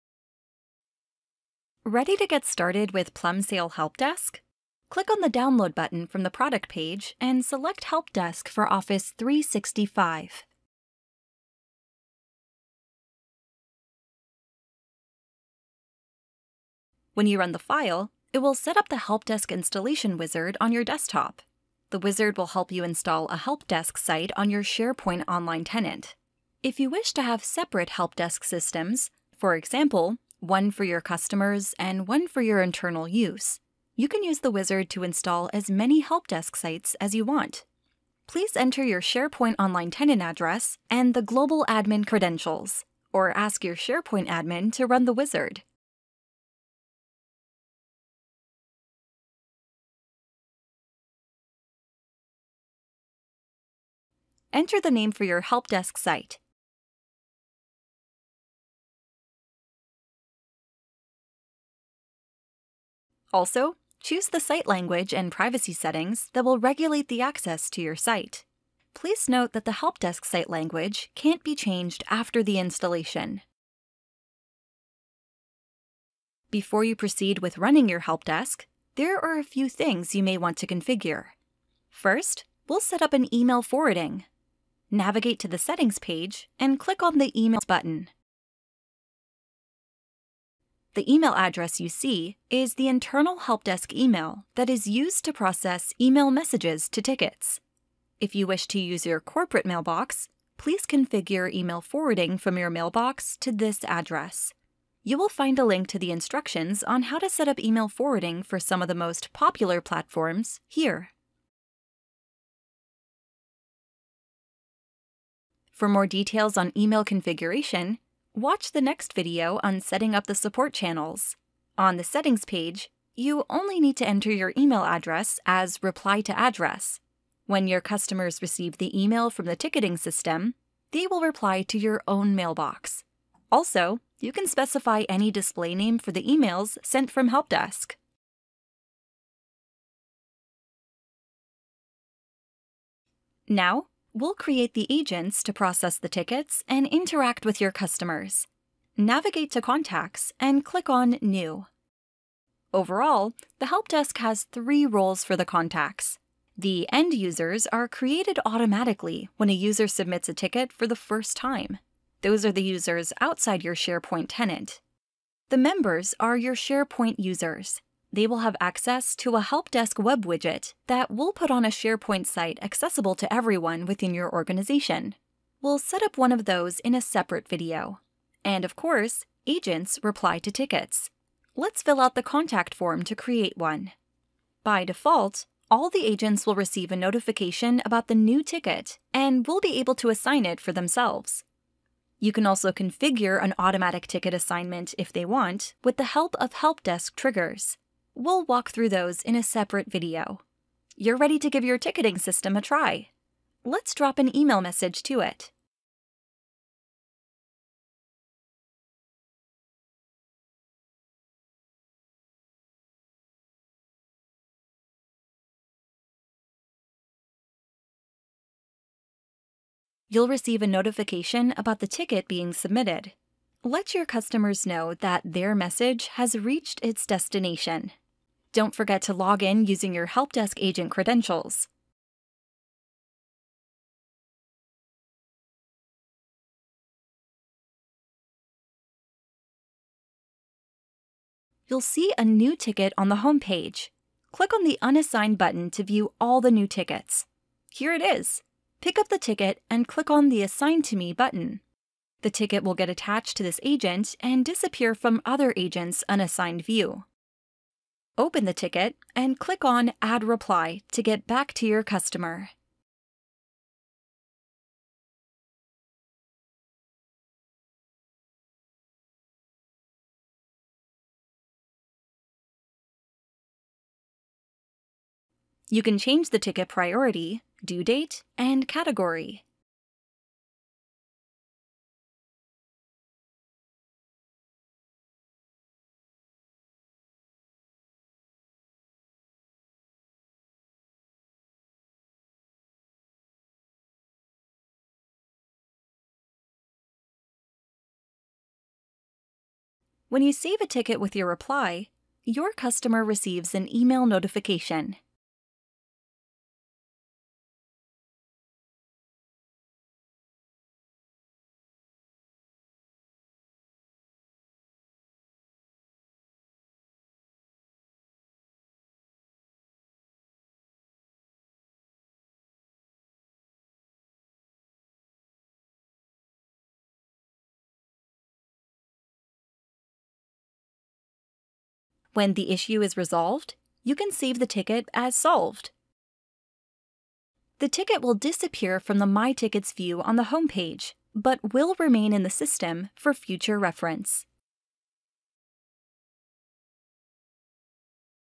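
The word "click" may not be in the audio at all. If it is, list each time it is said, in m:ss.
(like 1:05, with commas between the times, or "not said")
0:04, 1:26, 2:30, 4:04, 4:09, 4:19.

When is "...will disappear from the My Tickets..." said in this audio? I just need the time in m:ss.
5:38.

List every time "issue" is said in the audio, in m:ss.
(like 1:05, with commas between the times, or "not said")
5:32.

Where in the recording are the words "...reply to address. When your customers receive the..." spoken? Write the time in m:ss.
2:05.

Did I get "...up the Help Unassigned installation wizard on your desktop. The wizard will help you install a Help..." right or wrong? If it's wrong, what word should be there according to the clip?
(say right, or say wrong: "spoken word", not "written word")
wrong: "Desk", not "Unassigned".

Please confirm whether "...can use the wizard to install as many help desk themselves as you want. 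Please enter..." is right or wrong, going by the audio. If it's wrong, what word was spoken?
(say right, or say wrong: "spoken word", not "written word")
wrong: "sites", not "themselves".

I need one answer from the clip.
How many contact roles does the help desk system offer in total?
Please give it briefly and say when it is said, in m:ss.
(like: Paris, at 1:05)
3, at 2:34.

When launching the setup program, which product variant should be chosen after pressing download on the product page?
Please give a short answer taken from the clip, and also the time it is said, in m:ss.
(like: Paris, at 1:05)
Help Desk for Office 365, at 0:07.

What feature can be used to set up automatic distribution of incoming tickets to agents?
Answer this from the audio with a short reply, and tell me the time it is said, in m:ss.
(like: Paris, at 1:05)
Help desk triggers, at 3:16.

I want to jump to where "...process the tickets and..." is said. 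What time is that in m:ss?
2:25.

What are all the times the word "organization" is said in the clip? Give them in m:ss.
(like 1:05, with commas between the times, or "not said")
2:54.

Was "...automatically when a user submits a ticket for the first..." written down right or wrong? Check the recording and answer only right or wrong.
right.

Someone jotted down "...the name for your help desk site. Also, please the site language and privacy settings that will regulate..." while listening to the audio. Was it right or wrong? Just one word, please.
wrong.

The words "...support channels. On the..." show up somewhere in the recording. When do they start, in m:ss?
2:00.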